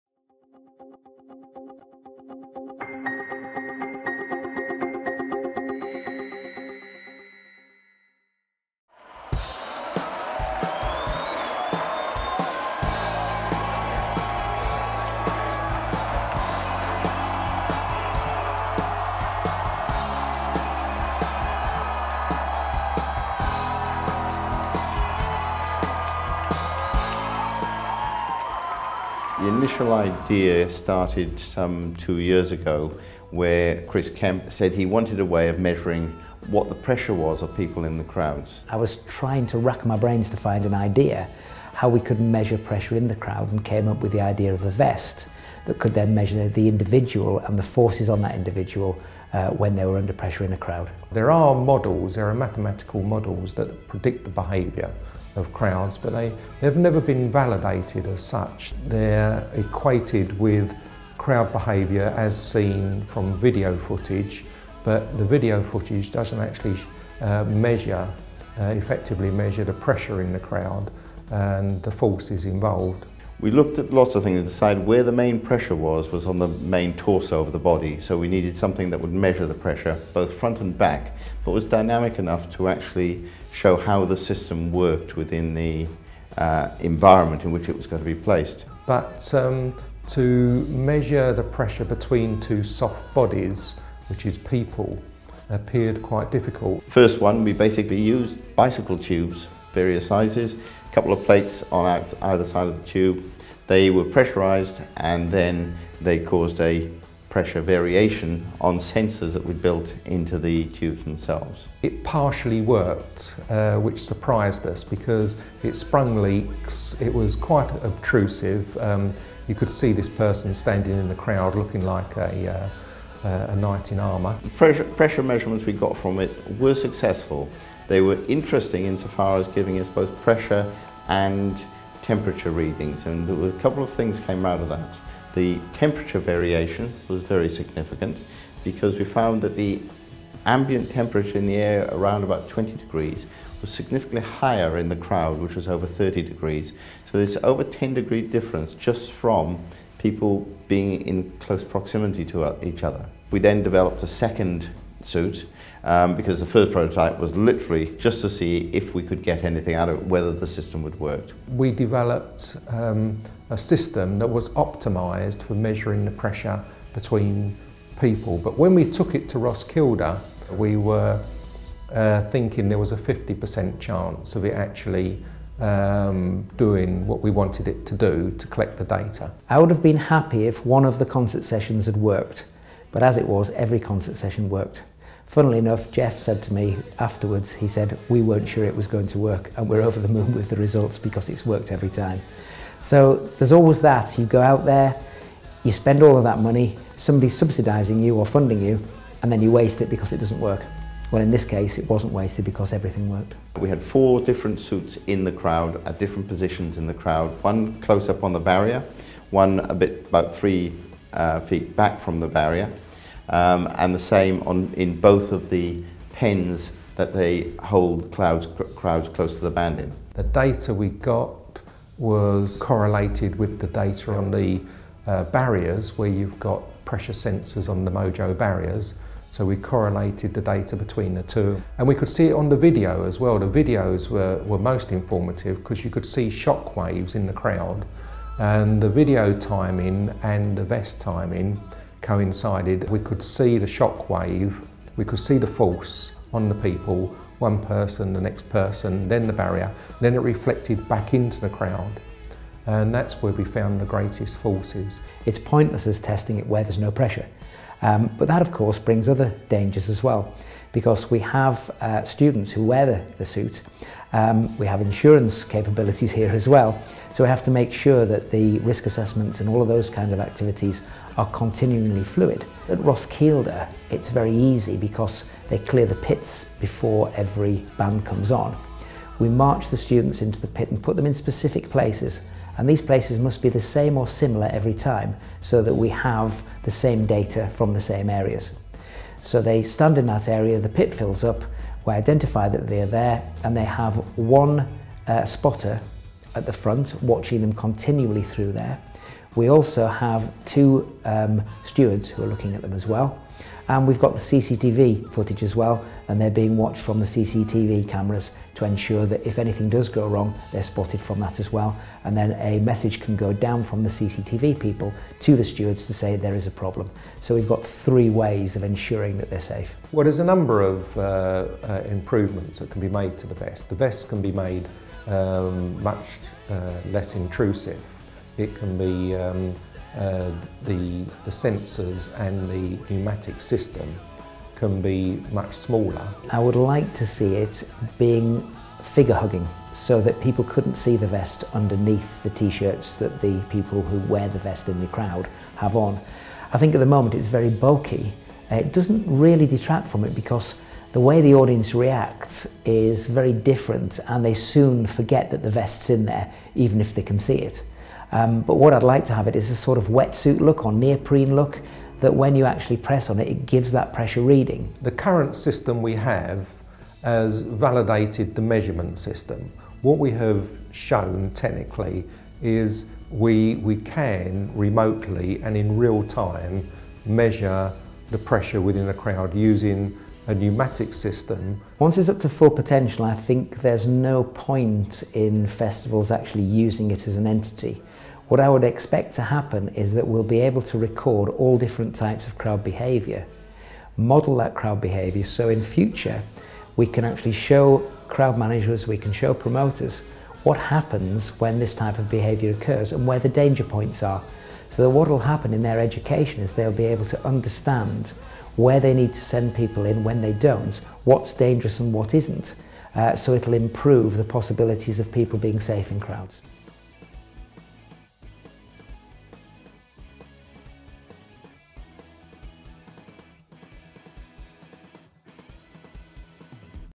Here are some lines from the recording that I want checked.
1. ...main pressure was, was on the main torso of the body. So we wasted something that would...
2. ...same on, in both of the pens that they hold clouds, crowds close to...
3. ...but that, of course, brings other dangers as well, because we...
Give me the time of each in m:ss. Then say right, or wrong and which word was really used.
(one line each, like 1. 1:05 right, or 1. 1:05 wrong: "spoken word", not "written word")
1. 1:15 wrong: "needed", not "wasted"
2. 3:33 right
3. 4:18 right.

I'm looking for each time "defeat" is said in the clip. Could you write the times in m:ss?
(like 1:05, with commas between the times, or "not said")
not said.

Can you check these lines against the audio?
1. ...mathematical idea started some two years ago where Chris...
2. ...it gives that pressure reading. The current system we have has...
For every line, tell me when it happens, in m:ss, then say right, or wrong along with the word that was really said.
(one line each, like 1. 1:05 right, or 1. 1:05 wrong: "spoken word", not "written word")
1. 0:29 wrong: "initial", not "mathematical"
2. 6:03 right.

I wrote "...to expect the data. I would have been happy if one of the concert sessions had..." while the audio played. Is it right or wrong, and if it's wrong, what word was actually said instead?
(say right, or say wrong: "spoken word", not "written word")
wrong: "collect", not "expect".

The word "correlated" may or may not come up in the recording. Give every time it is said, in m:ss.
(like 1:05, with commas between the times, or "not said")
3:42, 3:49.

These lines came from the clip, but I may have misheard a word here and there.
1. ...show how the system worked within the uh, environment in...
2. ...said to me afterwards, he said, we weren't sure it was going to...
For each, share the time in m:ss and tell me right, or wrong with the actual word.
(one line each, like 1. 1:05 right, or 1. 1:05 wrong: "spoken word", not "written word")
1. 1:23 right
2. 3:06 right.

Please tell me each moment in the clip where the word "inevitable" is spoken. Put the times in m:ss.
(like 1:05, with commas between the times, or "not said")
not said.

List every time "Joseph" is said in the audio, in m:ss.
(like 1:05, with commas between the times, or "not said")
not said.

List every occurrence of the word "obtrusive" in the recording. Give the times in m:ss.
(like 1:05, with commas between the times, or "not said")
1:57.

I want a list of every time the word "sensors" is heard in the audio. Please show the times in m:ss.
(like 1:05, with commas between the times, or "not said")
1:48, 3:47, 5:31.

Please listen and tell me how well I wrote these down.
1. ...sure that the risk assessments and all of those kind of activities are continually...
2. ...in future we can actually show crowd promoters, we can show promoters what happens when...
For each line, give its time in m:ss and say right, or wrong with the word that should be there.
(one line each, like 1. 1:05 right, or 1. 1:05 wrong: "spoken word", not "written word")
1. 4:27 right
2. 6:35 wrong: "managers", not "promoters".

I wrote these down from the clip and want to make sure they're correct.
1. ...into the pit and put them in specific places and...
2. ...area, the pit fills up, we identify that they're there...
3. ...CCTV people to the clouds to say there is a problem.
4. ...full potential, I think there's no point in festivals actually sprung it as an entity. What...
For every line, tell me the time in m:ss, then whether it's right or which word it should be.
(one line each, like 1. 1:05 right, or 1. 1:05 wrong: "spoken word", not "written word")
1. 4:40 right
2. 4:50 right
3. 5:13 wrong: "stewards", not "clouds"
4. 6:22 wrong: "using", not "sprung".